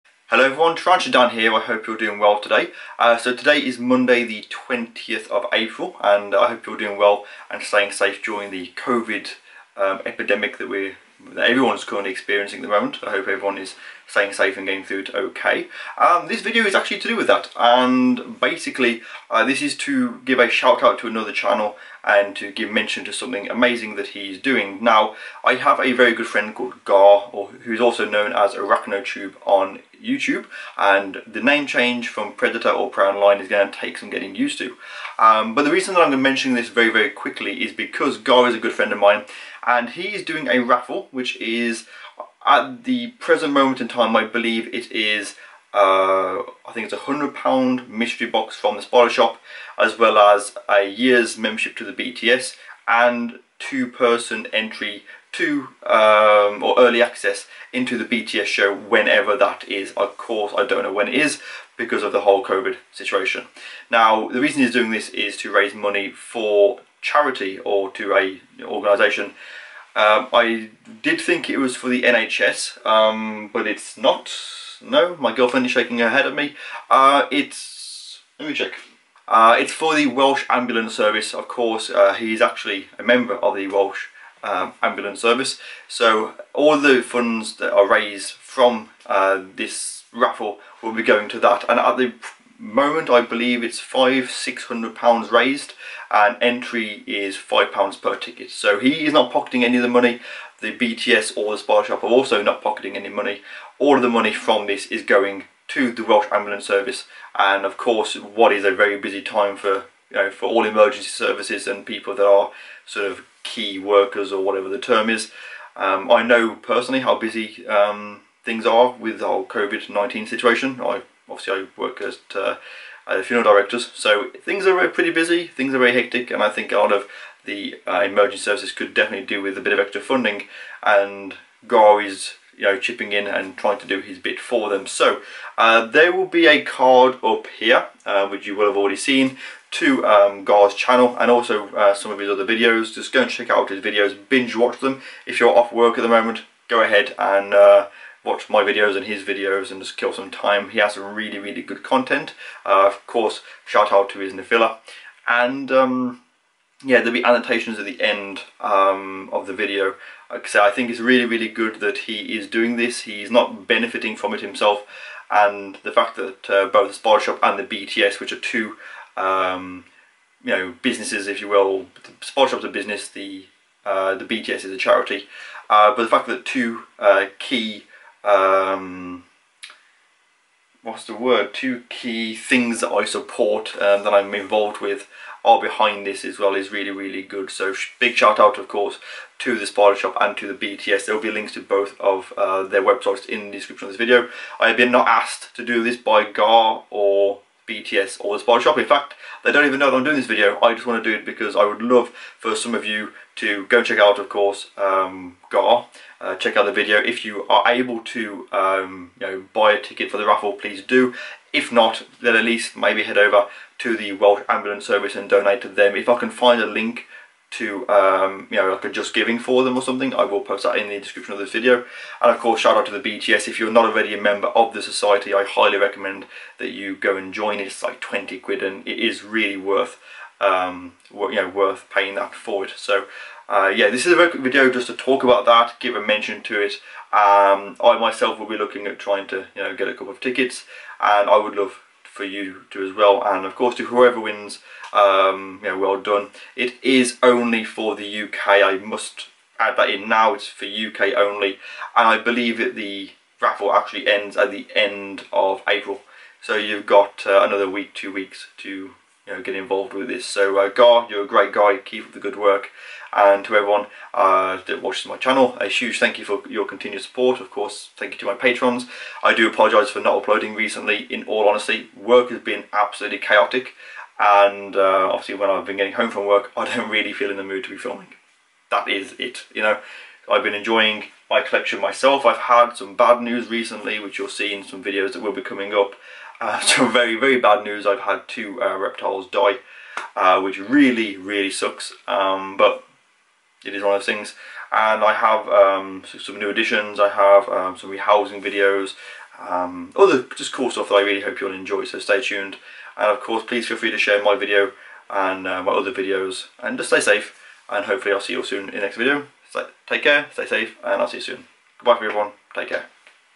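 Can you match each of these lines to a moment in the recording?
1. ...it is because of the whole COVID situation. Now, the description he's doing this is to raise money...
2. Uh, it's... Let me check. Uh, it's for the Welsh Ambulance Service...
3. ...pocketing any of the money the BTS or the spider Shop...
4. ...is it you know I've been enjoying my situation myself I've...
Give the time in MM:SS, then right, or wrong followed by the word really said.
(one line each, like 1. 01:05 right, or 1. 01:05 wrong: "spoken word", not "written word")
1. 01:01 wrong: "reason", not "description"
2. 01:16 right
3. 01:39 right
4. 04:38 wrong: "collection", not "situation".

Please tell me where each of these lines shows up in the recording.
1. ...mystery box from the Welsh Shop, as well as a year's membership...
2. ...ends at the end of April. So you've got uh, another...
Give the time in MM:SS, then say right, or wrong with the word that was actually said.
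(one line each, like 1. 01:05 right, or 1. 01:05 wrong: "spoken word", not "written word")
1. 00:47 wrong: "Spider", not "Welsh"
2. 04:14 right.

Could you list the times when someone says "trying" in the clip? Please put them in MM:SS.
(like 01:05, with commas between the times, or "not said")
02:13, 03:58.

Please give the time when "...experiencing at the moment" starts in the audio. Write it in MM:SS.
00:12.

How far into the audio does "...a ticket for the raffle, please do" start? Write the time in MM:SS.
03:29.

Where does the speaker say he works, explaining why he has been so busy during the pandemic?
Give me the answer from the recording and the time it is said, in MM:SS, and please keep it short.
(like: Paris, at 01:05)
funeral directors, at 02:03.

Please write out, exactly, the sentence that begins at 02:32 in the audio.
Uh, of course, shout out to his Nephila.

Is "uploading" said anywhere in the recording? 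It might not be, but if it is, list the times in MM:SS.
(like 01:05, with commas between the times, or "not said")
04:30.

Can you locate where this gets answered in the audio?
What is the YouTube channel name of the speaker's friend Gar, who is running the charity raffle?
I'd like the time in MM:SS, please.
00:28.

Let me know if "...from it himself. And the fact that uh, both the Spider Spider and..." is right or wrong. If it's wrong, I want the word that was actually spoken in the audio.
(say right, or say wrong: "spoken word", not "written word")
wrong: "Shop", not "Spider".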